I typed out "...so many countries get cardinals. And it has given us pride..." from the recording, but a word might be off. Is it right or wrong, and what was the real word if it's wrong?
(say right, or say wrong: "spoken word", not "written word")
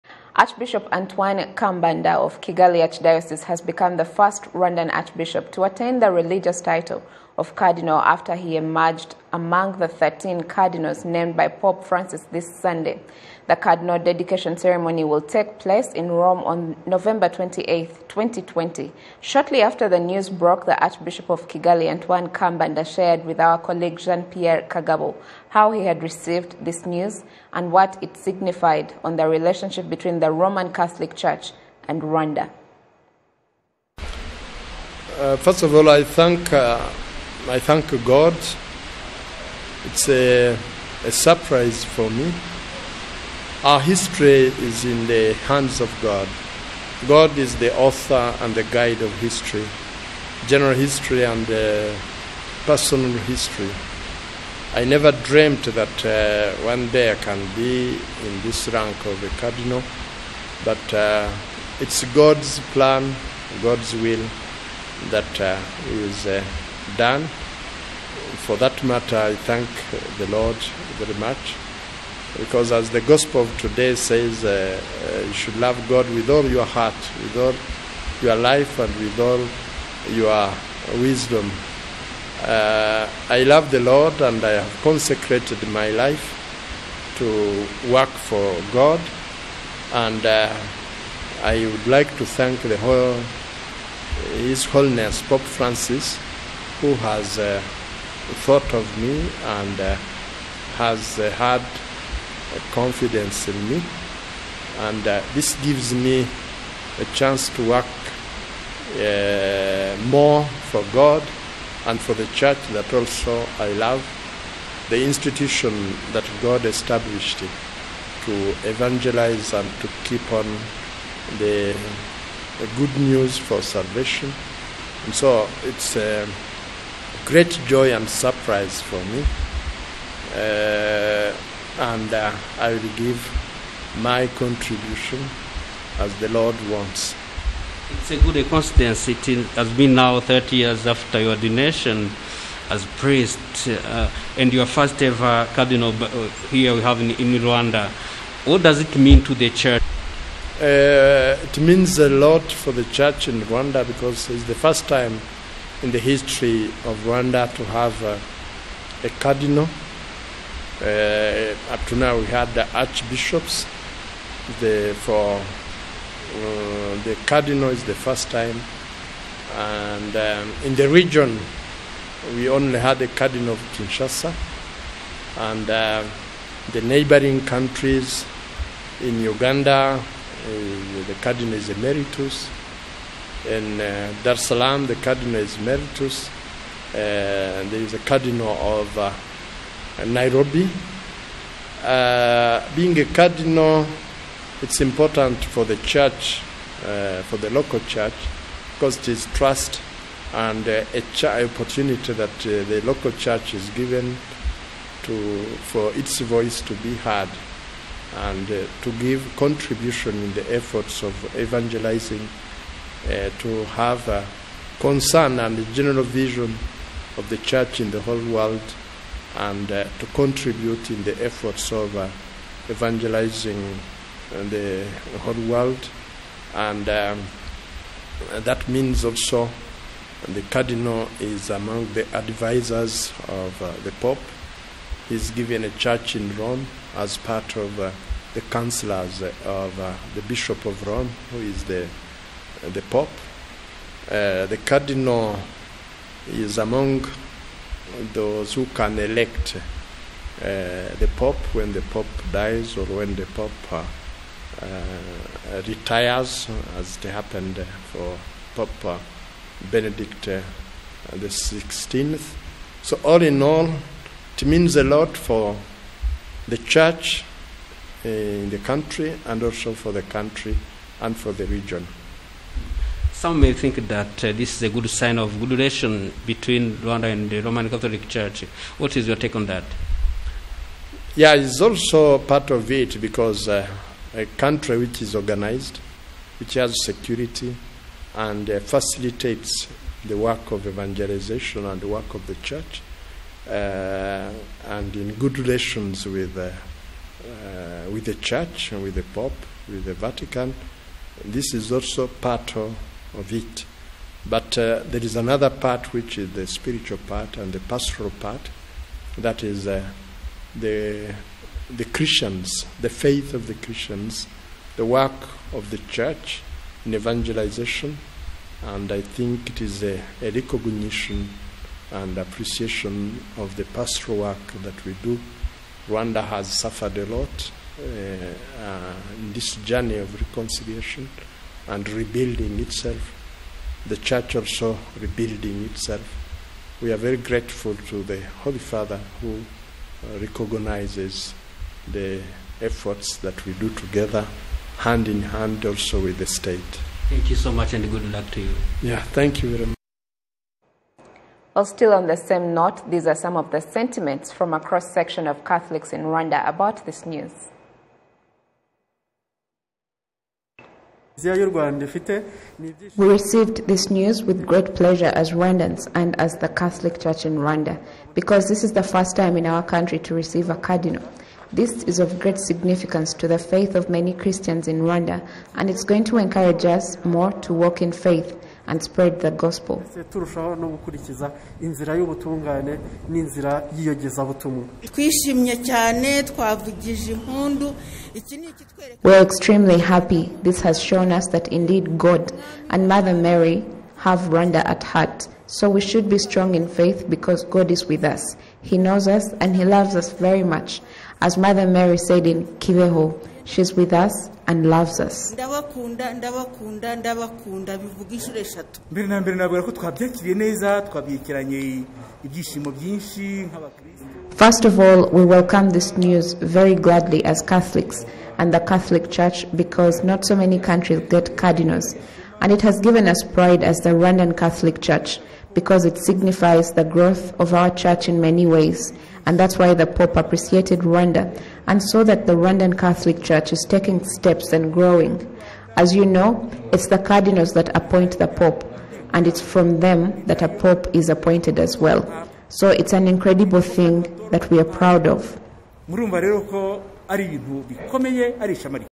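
right.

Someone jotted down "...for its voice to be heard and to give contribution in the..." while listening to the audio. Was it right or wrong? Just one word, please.
right.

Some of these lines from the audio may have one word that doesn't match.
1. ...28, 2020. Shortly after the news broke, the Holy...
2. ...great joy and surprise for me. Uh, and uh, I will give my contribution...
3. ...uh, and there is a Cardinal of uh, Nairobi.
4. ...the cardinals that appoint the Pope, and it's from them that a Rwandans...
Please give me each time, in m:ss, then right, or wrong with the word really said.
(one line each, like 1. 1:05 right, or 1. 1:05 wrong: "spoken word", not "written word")
1. 0:17 wrong: "Archbishop", not "Holy"
2. 2:07 right
3. 3:06 right
4. 7:16 wrong: "Pope", not "Rwandans".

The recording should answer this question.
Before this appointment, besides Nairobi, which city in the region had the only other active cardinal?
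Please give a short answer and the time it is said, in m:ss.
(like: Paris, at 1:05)
Kinshasa, at 2:53.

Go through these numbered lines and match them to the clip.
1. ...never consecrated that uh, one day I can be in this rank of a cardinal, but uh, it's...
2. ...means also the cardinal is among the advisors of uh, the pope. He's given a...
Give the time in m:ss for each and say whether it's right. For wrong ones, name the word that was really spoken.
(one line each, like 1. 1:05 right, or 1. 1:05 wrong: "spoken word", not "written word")
1. 0:54 wrong: "dreamed", not "consecrated"
2. 3:48 right.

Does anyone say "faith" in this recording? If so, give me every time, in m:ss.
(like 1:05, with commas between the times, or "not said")
5:12, 6:13, 6:17, 6:36.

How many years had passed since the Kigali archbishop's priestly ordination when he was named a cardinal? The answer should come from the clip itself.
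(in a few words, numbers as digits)
30.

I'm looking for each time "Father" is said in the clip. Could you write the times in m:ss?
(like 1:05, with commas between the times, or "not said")
5:38.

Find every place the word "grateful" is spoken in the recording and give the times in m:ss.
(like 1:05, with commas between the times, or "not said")
5:37.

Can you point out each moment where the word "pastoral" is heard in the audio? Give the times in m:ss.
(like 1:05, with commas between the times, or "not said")
5:07, 5:23.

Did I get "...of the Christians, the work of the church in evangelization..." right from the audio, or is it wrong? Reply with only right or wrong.
right.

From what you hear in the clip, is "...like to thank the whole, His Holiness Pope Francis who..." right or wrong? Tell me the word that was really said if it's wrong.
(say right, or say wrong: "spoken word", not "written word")
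right.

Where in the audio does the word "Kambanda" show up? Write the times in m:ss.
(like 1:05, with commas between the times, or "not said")
0:01, 0:22.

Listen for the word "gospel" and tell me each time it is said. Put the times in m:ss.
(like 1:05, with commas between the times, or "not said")
1:13, 6:19.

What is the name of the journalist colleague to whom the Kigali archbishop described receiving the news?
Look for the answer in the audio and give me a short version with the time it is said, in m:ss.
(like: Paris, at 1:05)
Jean Pierre Kagabo, at 0:23.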